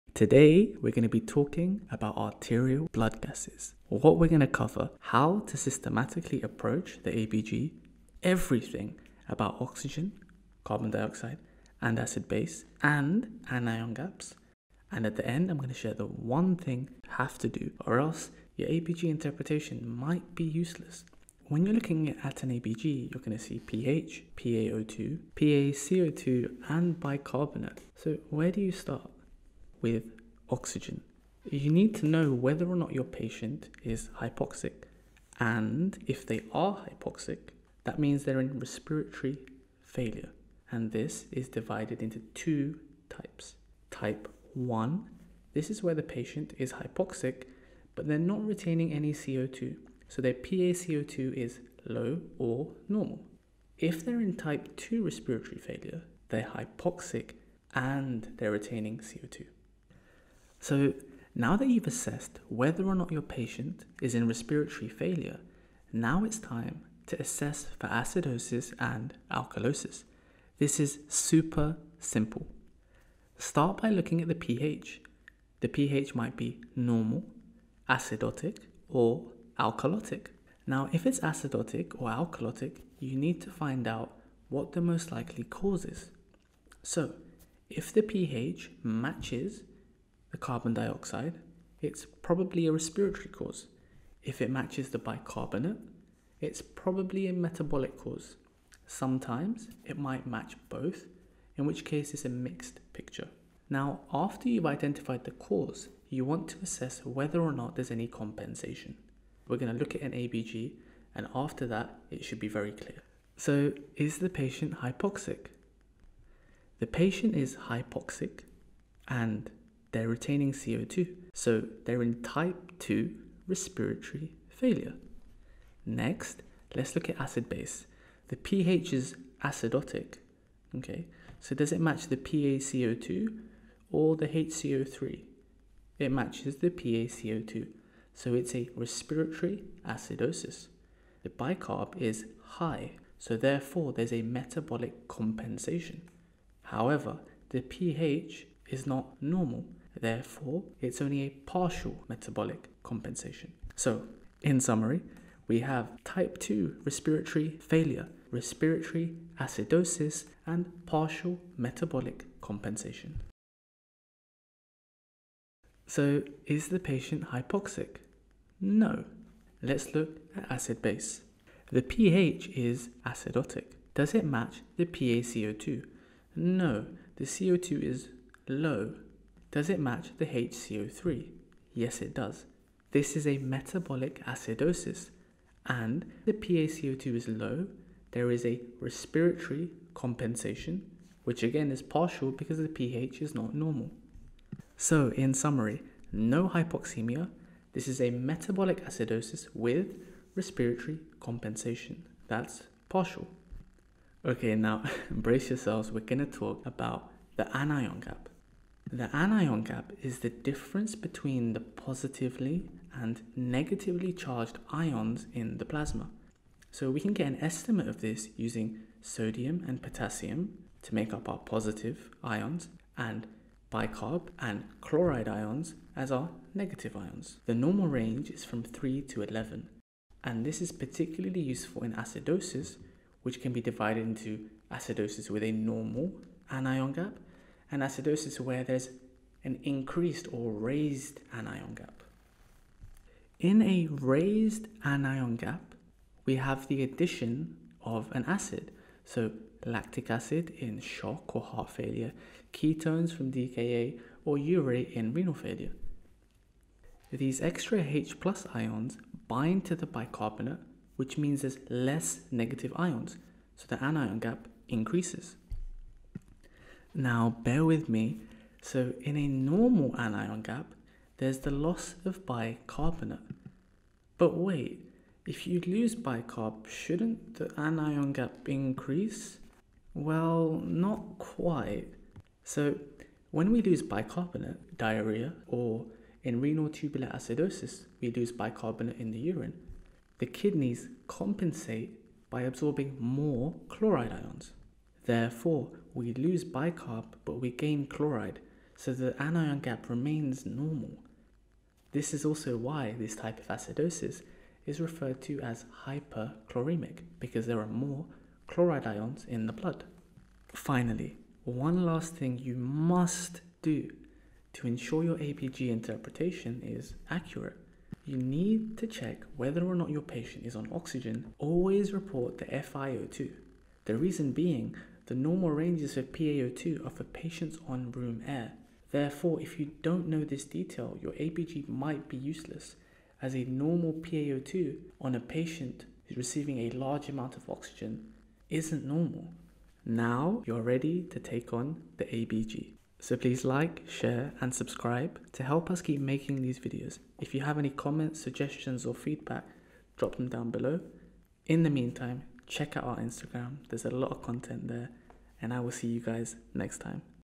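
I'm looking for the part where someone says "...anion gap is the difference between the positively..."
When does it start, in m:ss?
3:29.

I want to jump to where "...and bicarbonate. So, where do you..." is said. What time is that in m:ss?
0:26.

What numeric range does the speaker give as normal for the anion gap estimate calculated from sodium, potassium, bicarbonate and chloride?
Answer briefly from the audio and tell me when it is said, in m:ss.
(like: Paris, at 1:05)
3 to 11, at 3:48.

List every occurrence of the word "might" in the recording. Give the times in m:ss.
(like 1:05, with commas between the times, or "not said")
0:19, 1:16, 1:39, 5:31.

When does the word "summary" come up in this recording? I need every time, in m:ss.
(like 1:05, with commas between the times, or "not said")
2:34, 3:15.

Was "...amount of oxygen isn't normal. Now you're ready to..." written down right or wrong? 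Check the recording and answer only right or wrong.
right.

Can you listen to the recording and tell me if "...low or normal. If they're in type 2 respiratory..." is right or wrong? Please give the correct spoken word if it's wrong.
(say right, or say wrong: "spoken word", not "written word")
right.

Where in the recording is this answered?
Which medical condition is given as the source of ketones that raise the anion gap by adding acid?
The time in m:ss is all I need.
4:13.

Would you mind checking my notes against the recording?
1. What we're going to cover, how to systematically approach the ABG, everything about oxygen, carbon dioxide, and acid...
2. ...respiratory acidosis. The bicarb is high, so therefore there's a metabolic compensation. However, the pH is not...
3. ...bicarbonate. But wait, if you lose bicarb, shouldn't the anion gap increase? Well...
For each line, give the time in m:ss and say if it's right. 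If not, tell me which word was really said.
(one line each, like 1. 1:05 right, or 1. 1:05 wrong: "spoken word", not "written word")
1. 0:03 right
2. 2:18 right
3. 4:32 right.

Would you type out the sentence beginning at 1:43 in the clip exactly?
Now, after you've identified the cause, you want to assess whether or not there's any compensation.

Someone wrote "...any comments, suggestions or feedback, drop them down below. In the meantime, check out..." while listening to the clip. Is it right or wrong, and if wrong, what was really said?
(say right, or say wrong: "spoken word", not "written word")
right.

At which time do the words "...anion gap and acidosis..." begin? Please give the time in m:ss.
3:56.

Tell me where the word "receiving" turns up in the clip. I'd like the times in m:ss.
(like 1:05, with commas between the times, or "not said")
5:36.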